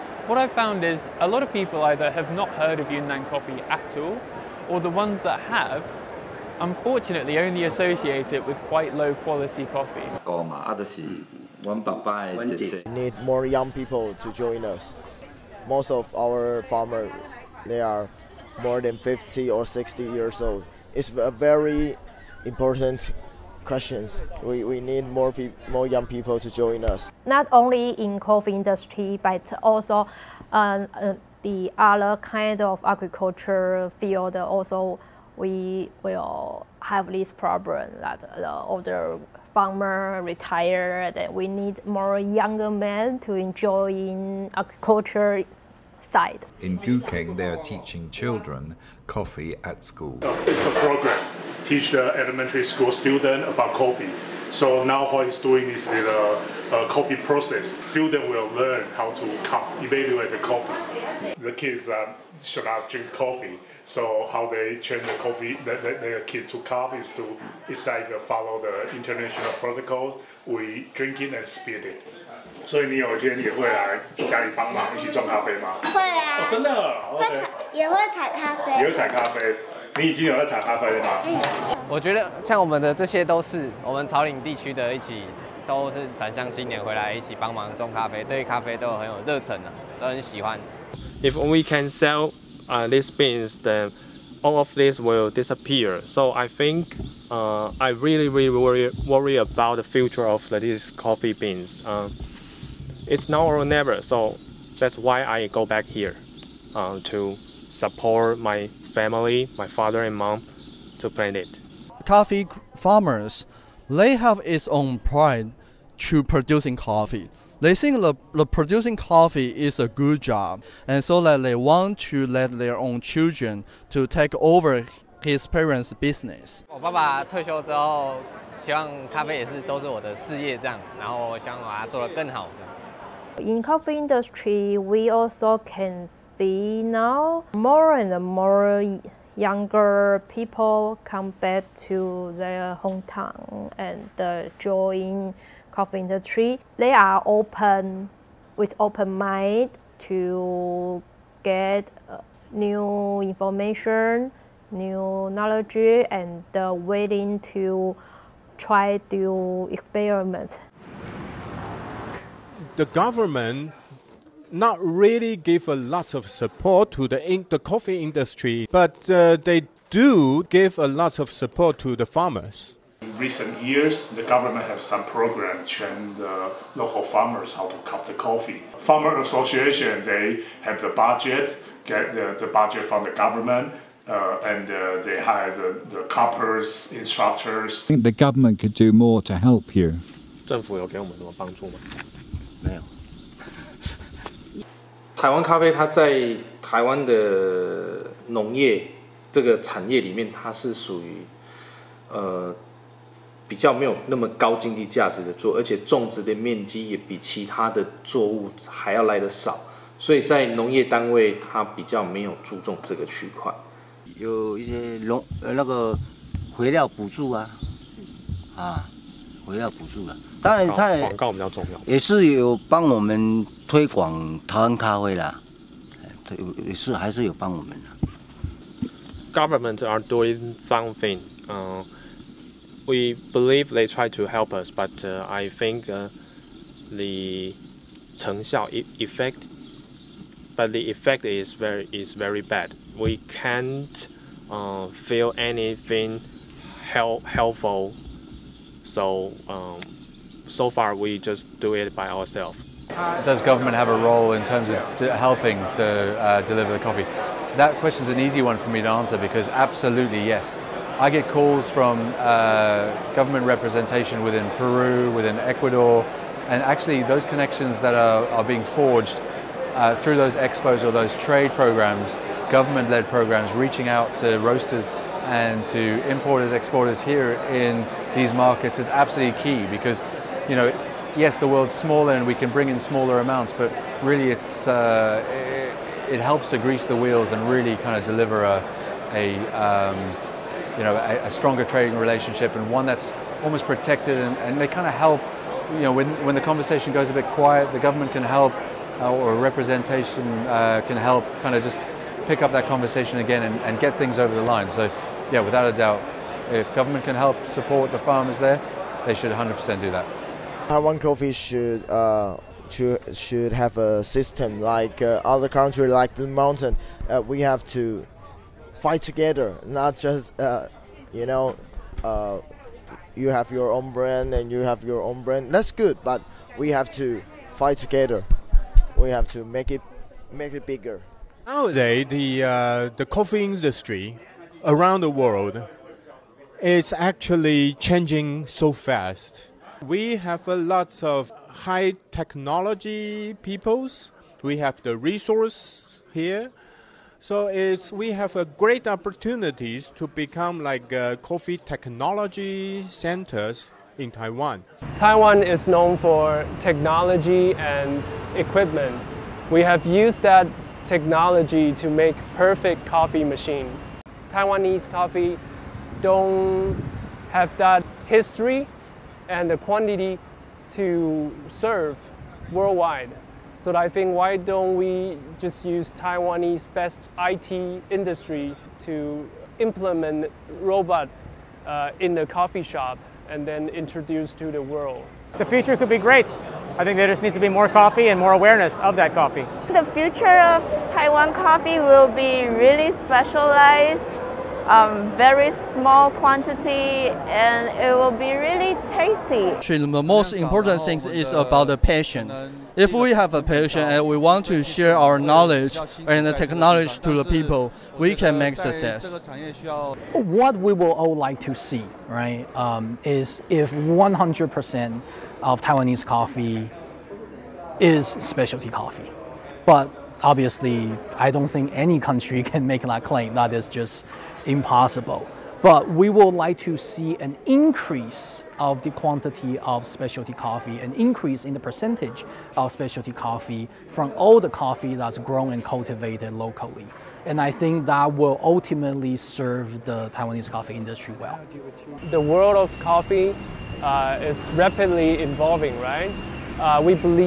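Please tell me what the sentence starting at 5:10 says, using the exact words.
Taiwan uh, coffee should uh, should should have a system like uh, other country like Blue Mountain.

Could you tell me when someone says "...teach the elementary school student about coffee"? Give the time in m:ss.
0:51.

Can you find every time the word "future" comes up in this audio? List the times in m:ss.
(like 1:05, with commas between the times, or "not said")
1:39, 6:25, 6:29.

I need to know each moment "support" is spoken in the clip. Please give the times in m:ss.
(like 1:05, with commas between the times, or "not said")
1:47, 2:46, 2:51, 5:07.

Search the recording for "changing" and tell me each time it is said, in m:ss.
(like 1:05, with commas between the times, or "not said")
5:37.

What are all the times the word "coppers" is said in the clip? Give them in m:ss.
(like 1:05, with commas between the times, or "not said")
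3:06.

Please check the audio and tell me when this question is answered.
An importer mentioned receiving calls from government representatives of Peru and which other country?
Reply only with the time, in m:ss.
4:25.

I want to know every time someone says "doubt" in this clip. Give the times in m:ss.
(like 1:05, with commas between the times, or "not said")
5:05.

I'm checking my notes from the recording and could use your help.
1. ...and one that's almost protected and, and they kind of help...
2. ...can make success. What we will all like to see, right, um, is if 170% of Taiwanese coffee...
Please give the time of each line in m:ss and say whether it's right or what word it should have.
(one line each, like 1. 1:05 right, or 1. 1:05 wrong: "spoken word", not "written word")
1. 4:52 right
2. 6:48 wrong: "100", not "170".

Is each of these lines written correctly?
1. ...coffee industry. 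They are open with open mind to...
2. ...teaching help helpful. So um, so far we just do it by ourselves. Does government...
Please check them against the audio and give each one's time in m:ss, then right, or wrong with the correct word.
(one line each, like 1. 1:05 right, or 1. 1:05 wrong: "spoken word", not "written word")
1. 2:25 right
2. 4:05 wrong: "anything", not "teaching".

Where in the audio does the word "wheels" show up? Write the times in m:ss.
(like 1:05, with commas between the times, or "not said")
4:46.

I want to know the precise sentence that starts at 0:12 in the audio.
Need more young people to join us.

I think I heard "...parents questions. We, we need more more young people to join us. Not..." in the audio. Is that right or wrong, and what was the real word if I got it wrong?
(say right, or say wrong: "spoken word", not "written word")
wrong: "important", not "parents".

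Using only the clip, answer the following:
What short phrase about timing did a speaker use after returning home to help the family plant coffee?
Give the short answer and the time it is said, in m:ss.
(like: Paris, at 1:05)
Now or never, at 1:43.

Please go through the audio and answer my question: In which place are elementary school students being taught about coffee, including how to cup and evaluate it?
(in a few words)
Gukeng.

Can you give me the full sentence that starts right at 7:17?
And I think that will ultimately serve the Taiwanese coffee industry well.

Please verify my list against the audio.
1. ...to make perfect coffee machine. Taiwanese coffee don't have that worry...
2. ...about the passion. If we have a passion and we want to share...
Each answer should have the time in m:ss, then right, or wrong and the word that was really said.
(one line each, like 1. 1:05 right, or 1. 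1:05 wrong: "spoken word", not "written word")
1. 6:01 wrong: "history", not "worry"
2. 6:41 right.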